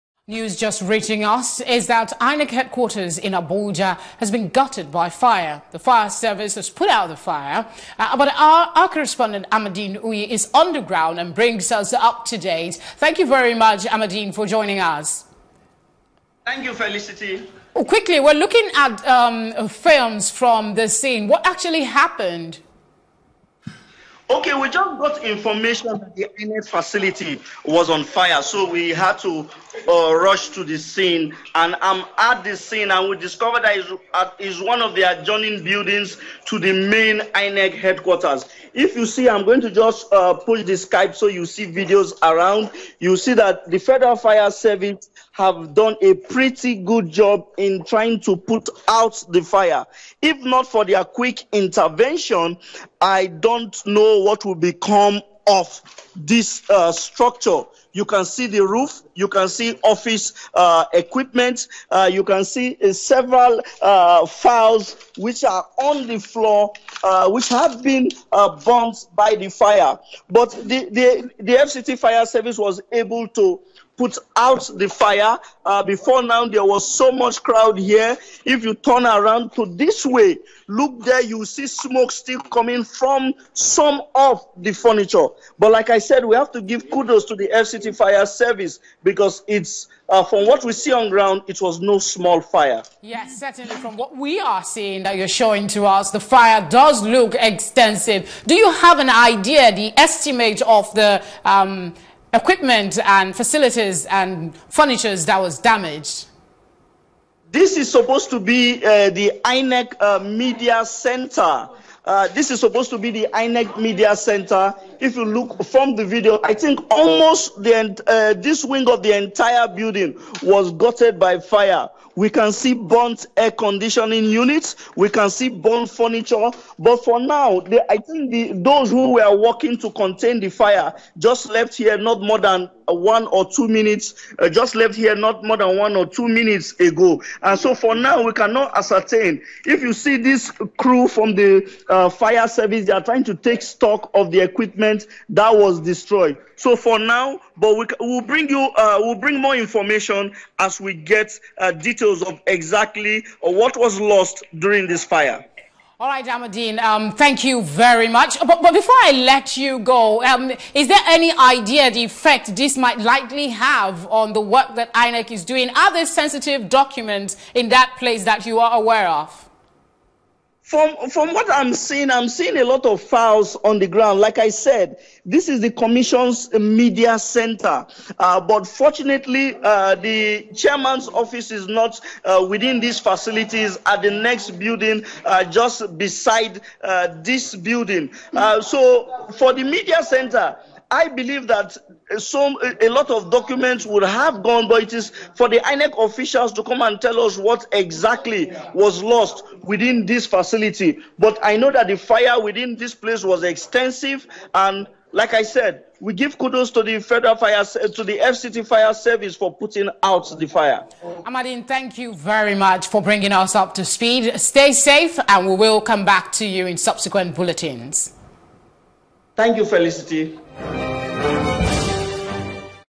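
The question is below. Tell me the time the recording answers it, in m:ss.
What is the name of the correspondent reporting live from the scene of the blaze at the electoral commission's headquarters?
0:09.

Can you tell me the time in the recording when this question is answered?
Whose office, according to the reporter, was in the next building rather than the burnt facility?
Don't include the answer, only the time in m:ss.
2:59.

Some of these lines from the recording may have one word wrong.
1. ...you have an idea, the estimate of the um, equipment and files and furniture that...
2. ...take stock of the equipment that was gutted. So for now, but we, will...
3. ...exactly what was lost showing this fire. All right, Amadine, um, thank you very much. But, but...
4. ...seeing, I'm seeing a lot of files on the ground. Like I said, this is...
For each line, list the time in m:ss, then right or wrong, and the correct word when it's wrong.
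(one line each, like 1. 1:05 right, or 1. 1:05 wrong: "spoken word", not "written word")
1. 1:38 wrong: "facilities", not "files"
2. 2:23 wrong: "destroyed", not "gutted"
3. 2:32 wrong: "during", not "showing"
4. 2:51 right.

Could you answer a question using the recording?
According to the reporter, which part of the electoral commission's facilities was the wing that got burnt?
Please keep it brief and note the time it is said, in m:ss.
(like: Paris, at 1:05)
INEC Media Center, at 1:53.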